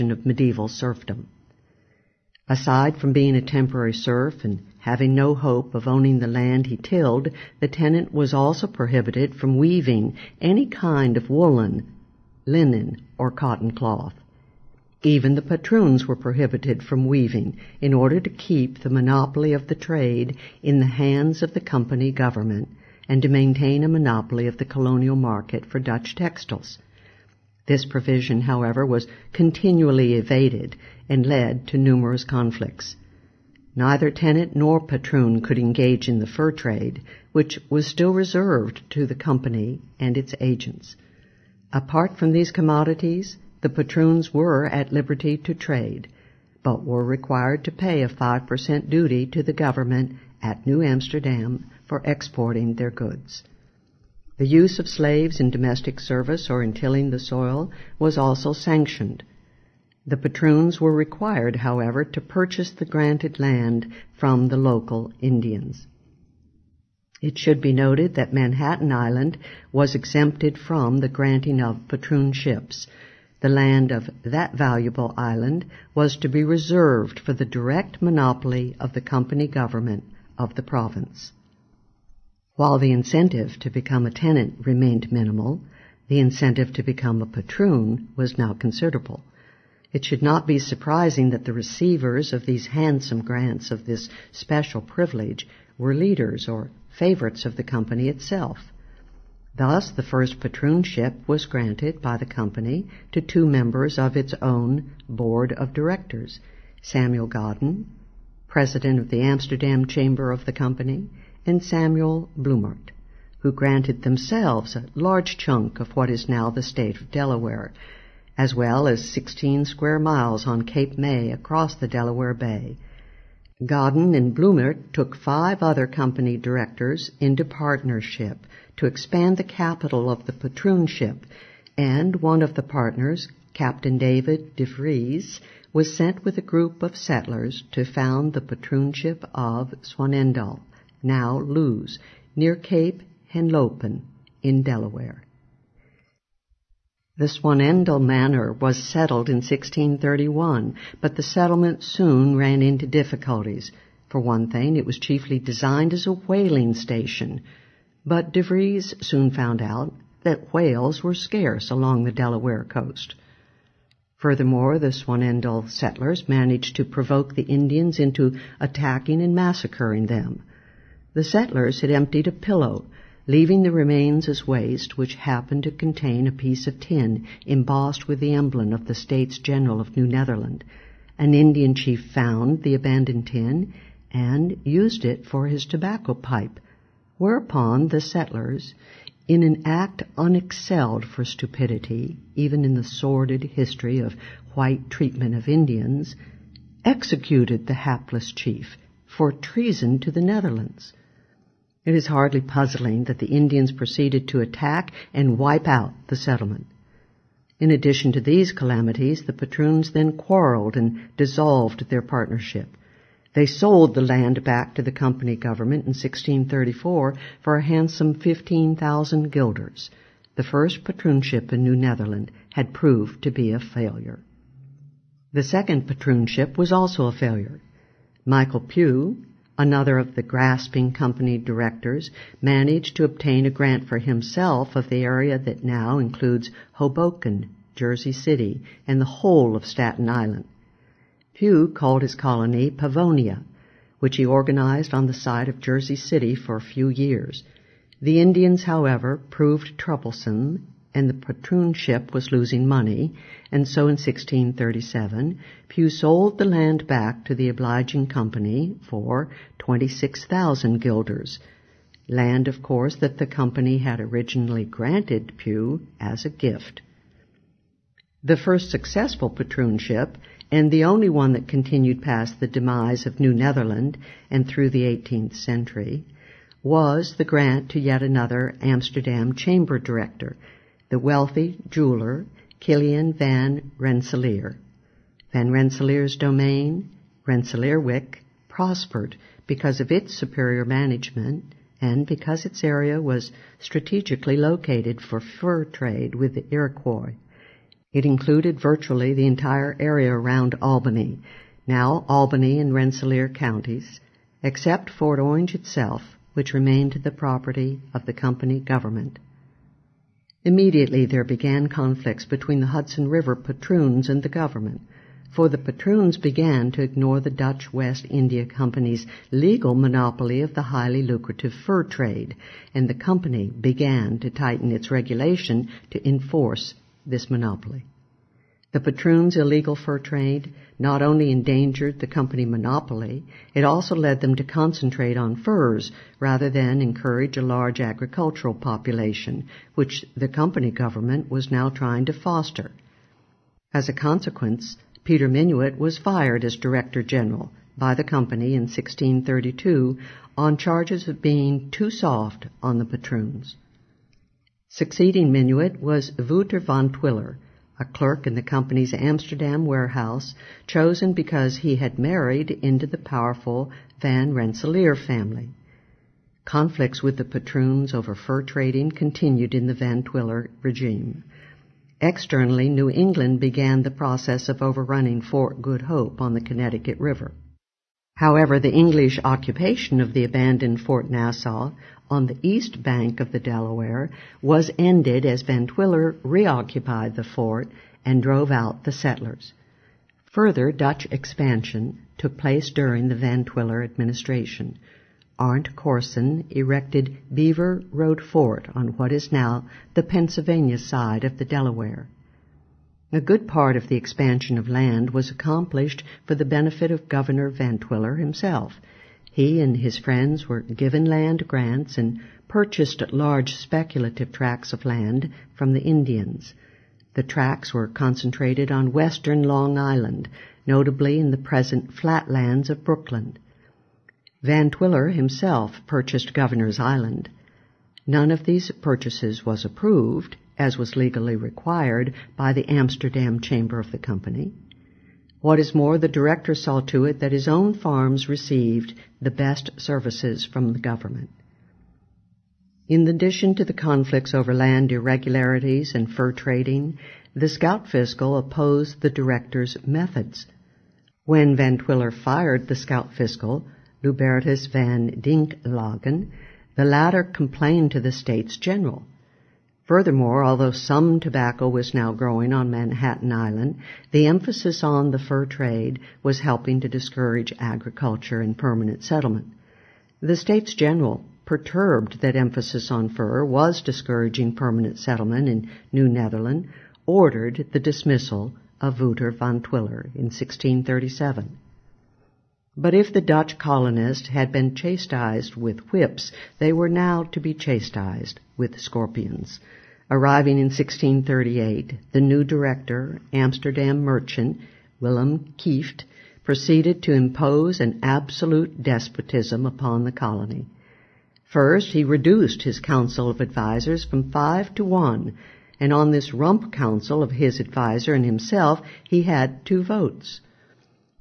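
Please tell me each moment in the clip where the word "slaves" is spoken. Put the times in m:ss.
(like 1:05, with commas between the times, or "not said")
0:54.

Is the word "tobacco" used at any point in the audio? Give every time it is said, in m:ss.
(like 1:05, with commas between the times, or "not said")
3:05, 7:41.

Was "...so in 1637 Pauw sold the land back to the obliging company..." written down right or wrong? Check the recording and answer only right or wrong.
right.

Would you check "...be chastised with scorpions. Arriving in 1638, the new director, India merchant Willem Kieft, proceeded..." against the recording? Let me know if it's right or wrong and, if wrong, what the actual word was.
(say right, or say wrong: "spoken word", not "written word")
wrong: "Amsterdam", not "India".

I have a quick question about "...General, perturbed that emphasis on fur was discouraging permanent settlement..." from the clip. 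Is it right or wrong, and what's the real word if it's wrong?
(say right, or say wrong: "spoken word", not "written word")
right.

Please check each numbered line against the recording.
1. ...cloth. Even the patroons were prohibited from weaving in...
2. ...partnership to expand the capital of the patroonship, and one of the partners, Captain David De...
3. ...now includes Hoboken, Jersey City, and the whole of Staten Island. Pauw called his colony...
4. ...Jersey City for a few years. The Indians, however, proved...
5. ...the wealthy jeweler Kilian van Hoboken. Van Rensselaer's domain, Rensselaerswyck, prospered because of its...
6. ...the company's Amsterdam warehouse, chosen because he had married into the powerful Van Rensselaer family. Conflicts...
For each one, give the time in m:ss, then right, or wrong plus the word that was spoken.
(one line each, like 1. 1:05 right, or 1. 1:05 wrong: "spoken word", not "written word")
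1. 0:13 right
2. 2:07 right
3. 3:55 right
4. 4:05 right
5. 4:40 wrong: "Rensselaer", not "Hoboken"
6. 5:58 right.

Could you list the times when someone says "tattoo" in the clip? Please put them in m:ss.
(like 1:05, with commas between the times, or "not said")
not said.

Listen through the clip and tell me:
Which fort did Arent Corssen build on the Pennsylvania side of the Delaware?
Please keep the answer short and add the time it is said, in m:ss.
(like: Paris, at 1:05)
Beversreede Fort, at 6:37.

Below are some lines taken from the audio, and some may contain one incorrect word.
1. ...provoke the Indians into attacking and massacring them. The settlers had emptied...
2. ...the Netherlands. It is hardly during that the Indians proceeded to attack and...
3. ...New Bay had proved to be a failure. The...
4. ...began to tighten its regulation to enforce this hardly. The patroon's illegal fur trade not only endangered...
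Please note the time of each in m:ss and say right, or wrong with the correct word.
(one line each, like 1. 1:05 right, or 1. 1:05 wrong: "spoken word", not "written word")
1. 2:46 right
2. 3:20 wrong: "puzzling", not "during"
3. 3:41 wrong: "Netherland", not "Bay"
4. 5:23 wrong: "monopoly", not "hardly".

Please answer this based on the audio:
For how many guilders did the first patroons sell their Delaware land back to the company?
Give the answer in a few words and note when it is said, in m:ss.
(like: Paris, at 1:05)
15,000 guilders, at 3:38.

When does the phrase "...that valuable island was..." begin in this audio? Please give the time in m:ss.
1:14.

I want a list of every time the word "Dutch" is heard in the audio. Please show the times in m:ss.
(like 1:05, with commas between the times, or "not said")
0:25, 5:17, 6:30, 8:03.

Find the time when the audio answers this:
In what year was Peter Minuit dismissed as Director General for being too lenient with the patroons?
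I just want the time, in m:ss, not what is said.
5:48.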